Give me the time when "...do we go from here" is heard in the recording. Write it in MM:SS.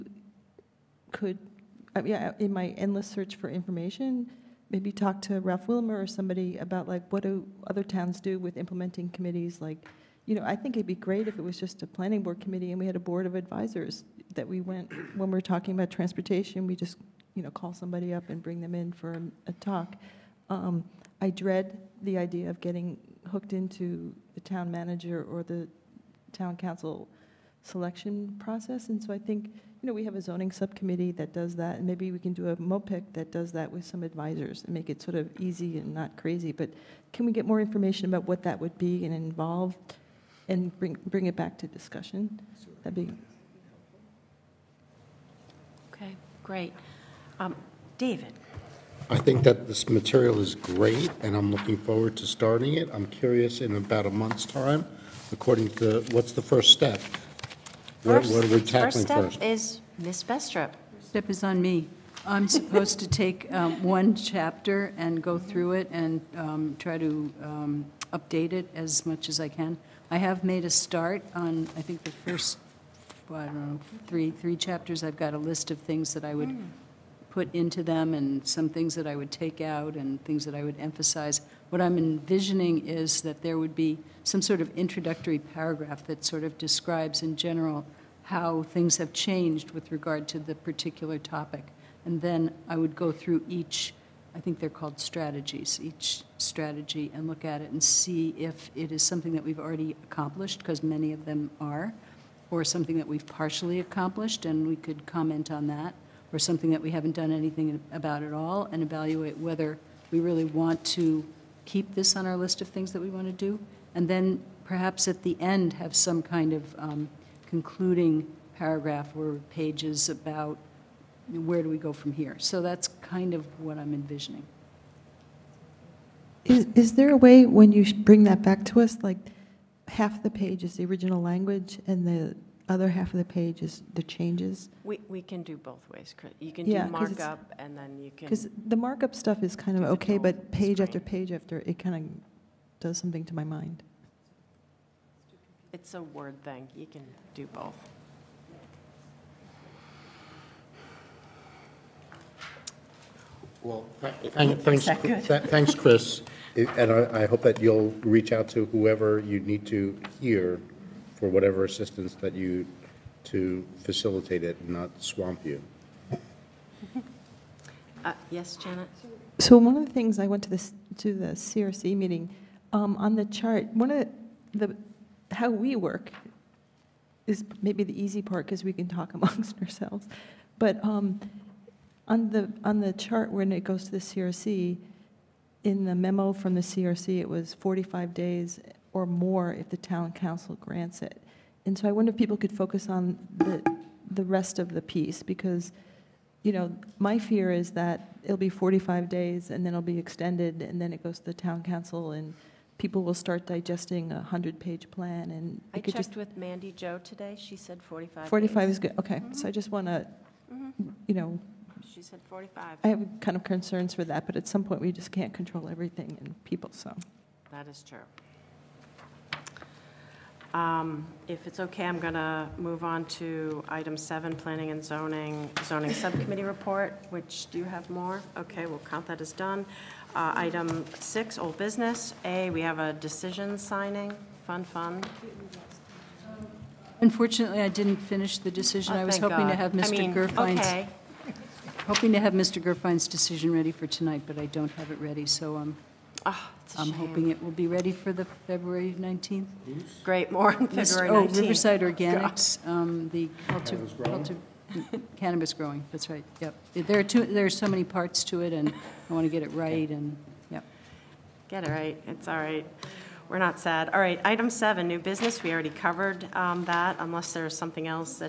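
02:01.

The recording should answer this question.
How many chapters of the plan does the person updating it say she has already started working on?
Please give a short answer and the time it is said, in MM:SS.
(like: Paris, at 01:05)
3, at 01:14.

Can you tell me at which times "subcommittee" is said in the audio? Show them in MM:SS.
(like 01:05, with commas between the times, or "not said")
00:30, 03:45.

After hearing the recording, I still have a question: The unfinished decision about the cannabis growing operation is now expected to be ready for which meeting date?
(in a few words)
February 19th.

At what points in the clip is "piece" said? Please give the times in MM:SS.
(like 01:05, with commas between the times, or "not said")
03:14.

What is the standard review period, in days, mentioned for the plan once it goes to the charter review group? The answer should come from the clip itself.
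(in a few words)
45 days.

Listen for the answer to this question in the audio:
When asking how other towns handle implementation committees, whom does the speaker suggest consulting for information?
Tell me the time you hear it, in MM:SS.
00:05.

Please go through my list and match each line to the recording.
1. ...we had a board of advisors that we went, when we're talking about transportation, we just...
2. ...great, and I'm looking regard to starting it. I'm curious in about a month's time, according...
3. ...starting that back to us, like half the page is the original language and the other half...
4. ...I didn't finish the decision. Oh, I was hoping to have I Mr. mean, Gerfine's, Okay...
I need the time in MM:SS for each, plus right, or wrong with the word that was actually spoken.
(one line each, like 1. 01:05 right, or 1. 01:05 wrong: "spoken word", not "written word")
1. 00:12 right
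2. 00:50 wrong: "forward", not "regard"
3. 02:07 wrong: "bring", not "starting"
4. 03:57 right.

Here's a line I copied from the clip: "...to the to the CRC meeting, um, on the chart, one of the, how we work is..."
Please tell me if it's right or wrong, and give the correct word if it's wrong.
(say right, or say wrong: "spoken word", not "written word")
right.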